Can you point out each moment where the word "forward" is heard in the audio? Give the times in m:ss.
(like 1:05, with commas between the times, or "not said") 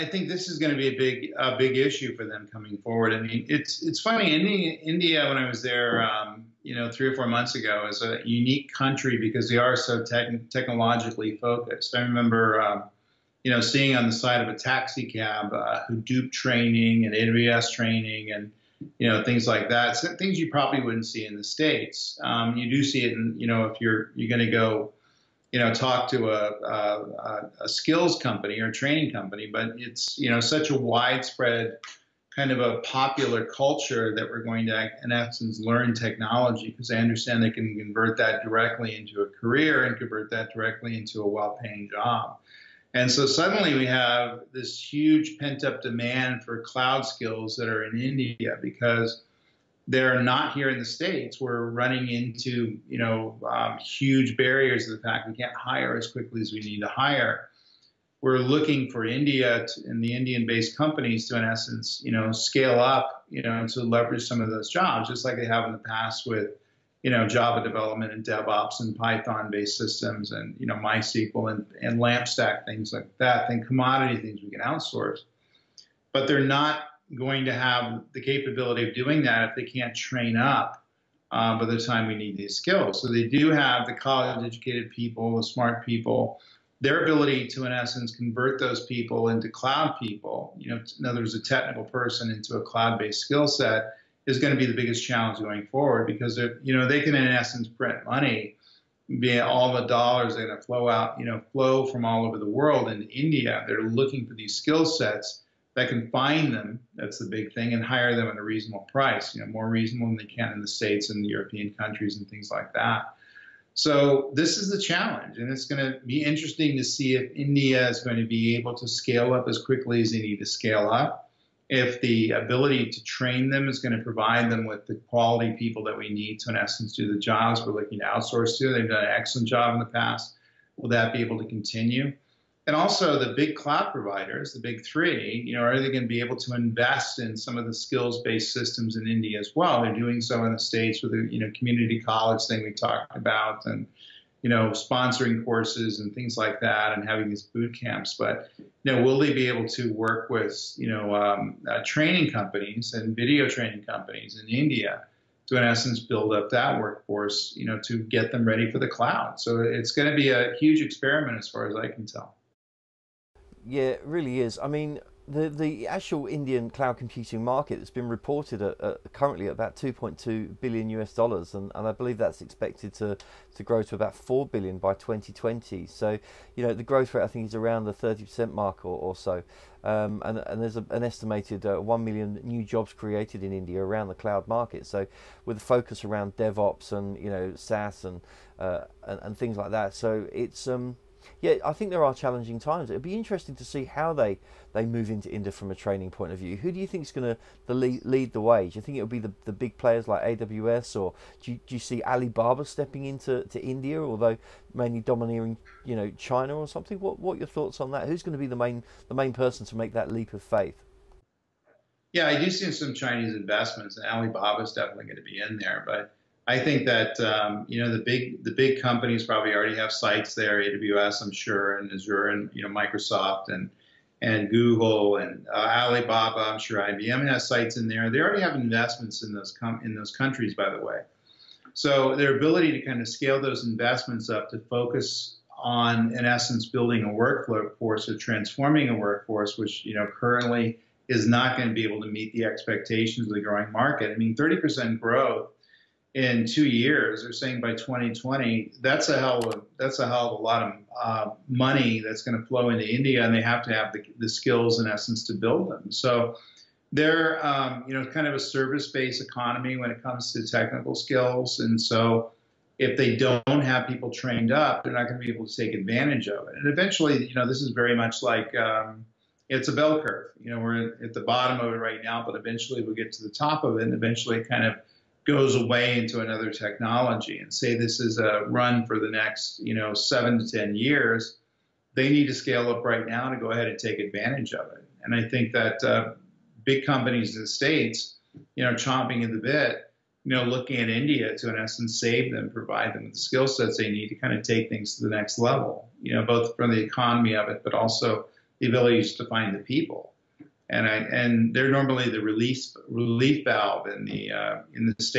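0:02, 1:35.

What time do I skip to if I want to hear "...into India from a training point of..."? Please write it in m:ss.
3:15.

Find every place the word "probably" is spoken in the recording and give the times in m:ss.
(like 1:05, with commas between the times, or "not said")
0:20, 3:39.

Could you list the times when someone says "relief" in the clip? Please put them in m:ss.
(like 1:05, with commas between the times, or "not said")
5:02.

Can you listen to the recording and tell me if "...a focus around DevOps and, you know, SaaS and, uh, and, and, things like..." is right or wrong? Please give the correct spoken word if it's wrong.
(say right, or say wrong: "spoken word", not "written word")
right.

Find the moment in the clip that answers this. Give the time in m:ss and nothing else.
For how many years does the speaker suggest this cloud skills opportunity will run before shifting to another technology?
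4:39.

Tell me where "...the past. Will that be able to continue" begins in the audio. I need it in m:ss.
2:09.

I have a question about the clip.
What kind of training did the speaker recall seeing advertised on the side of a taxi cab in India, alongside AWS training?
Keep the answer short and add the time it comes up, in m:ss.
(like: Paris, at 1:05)
Hadoop training, at 0:15.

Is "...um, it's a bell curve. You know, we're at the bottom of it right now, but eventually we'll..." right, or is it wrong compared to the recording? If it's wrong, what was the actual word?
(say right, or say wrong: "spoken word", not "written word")
right.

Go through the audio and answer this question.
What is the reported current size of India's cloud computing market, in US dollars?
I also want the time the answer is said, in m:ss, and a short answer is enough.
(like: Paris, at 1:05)
2.2 billion, at 2:49.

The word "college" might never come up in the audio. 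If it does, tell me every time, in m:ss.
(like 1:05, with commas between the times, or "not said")
1:23, 2:22.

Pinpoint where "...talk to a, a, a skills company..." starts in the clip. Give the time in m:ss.
0:25.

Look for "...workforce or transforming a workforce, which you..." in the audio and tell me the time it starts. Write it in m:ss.
3:57.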